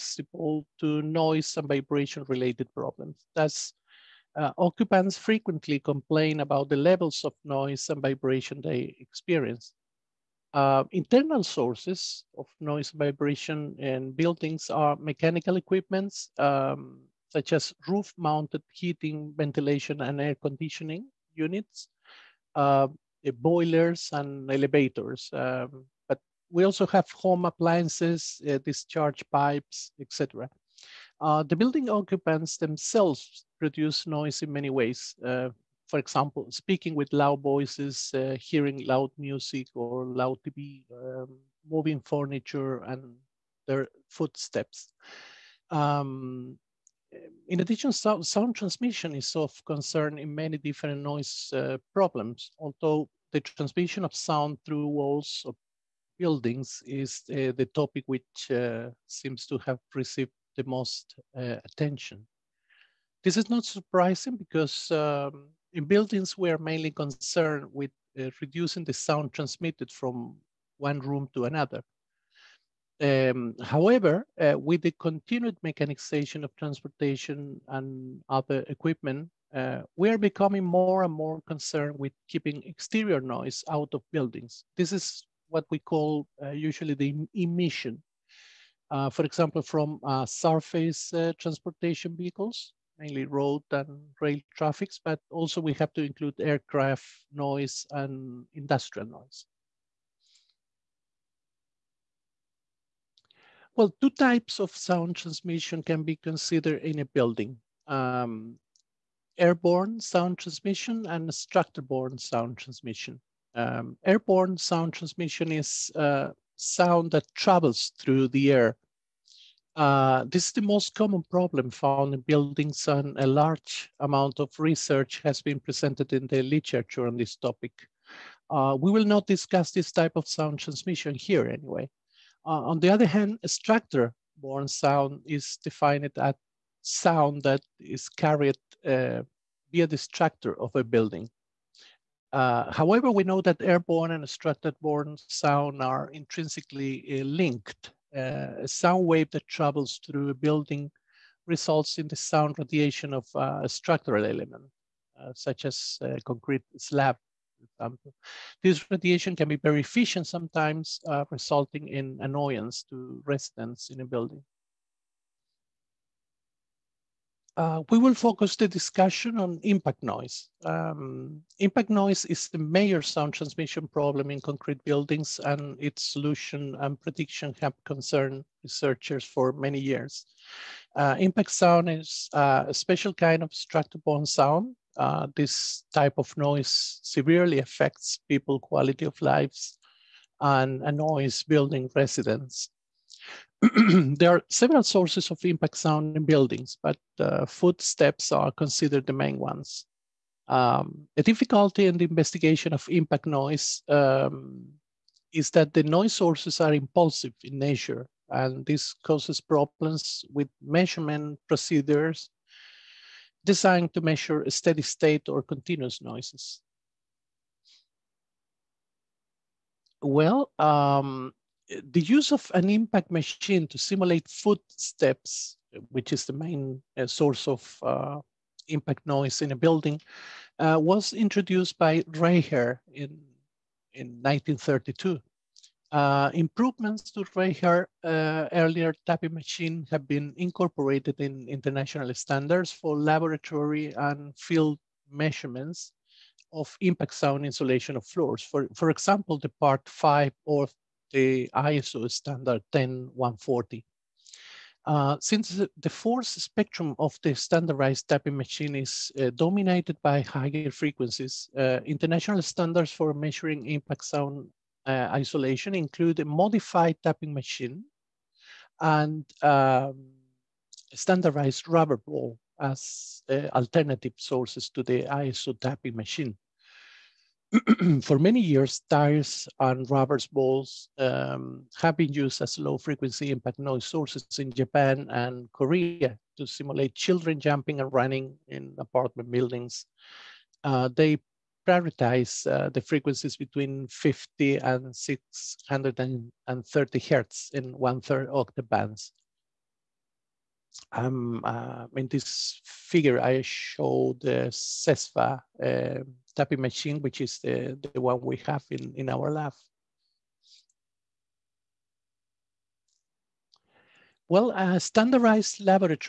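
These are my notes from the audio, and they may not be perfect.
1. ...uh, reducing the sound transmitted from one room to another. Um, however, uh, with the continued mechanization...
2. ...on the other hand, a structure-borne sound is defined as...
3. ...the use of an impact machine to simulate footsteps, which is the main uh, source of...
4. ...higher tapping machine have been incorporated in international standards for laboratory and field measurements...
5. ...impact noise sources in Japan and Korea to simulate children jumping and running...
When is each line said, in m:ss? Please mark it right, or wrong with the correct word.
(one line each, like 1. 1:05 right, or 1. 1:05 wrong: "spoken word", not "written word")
1. 1:08 right
2. 2:12 right
3. 3:41 right
4. 3:58 wrong: "earlier", not "higher"
5. 4:43 right.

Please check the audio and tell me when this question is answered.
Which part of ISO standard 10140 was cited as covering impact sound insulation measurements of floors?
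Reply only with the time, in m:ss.
4:09.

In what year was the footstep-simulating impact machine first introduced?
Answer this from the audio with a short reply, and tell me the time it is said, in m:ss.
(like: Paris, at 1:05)
1932, at 3:54.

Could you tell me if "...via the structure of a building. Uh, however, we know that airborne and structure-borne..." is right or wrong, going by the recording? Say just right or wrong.
right.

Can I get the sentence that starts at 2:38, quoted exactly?
This radiation can be very efficient sometimes, resulting in annoyance to residents in a building.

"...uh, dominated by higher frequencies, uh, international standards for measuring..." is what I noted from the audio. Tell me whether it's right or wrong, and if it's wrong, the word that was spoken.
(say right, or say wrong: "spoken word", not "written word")
right.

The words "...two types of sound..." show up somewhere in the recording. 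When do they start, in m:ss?
1:44.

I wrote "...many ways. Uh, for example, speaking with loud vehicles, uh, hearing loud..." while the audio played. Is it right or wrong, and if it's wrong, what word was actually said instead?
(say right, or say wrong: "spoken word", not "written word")
wrong: "voices", not "vehicles".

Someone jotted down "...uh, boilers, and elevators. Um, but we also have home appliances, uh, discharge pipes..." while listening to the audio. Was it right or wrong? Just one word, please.
right.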